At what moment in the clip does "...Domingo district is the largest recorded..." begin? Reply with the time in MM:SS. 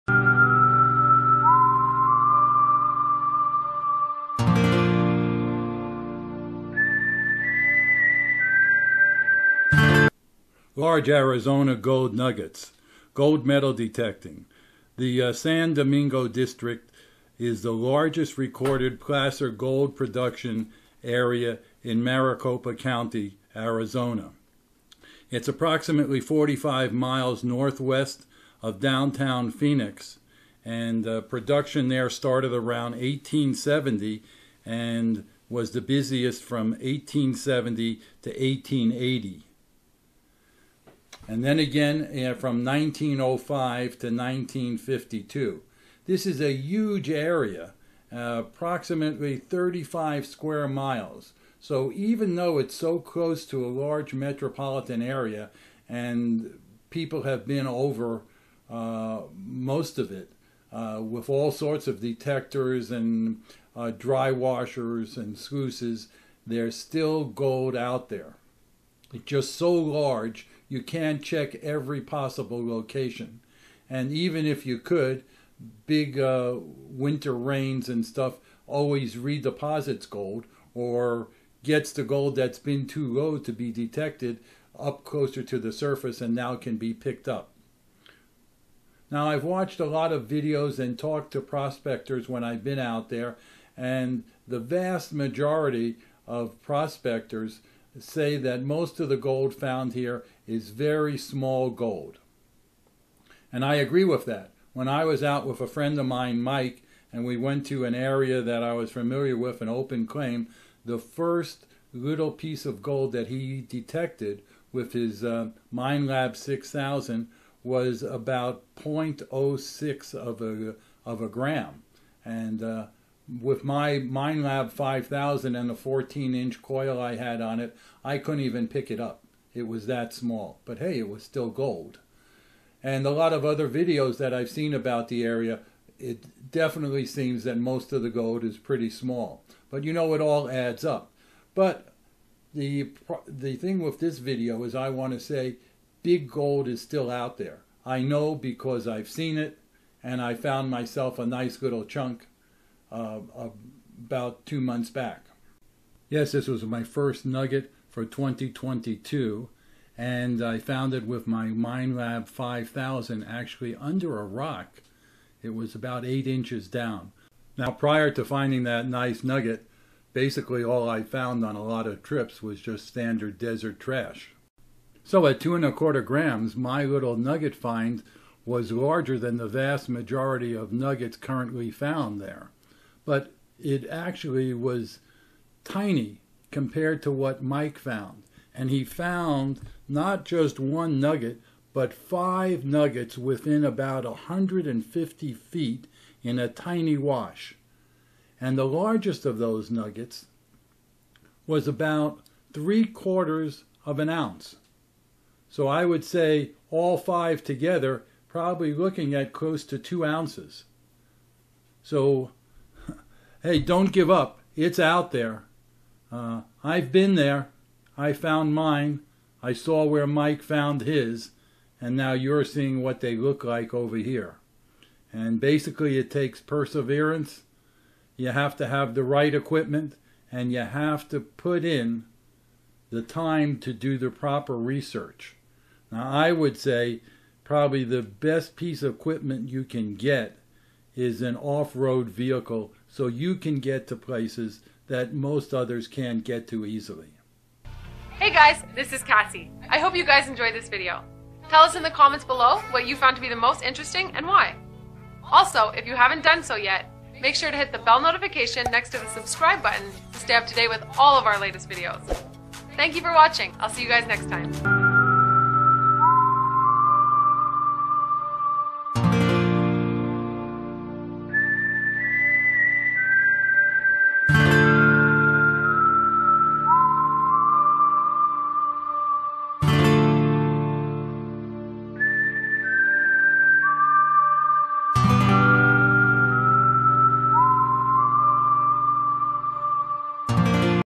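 00:15.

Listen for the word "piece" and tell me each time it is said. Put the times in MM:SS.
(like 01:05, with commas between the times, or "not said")
01:52, 03:58.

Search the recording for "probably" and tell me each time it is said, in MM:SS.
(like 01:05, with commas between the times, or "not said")
03:28, 03:57.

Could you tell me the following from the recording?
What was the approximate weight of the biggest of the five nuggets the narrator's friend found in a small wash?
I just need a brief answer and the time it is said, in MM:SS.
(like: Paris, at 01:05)
3/4 of an ounce, at 03:22.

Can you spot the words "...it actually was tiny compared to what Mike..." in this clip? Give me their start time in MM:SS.
03:03.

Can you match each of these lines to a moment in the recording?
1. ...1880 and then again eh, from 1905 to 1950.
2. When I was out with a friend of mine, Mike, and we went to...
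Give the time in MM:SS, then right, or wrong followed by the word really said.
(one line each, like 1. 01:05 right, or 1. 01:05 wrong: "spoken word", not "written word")
1. 00:38 wrong: "1952", not "1950"
2. 01:44 right.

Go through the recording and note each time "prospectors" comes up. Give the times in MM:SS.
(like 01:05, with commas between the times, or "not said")
01:31, 01:36.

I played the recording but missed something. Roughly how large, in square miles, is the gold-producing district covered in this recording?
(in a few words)
35 square miles.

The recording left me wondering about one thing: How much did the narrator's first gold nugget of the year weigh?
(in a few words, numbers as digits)
2.25 grams.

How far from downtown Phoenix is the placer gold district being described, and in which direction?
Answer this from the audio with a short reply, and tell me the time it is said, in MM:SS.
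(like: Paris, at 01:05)
45 miles northwest, at 00:26.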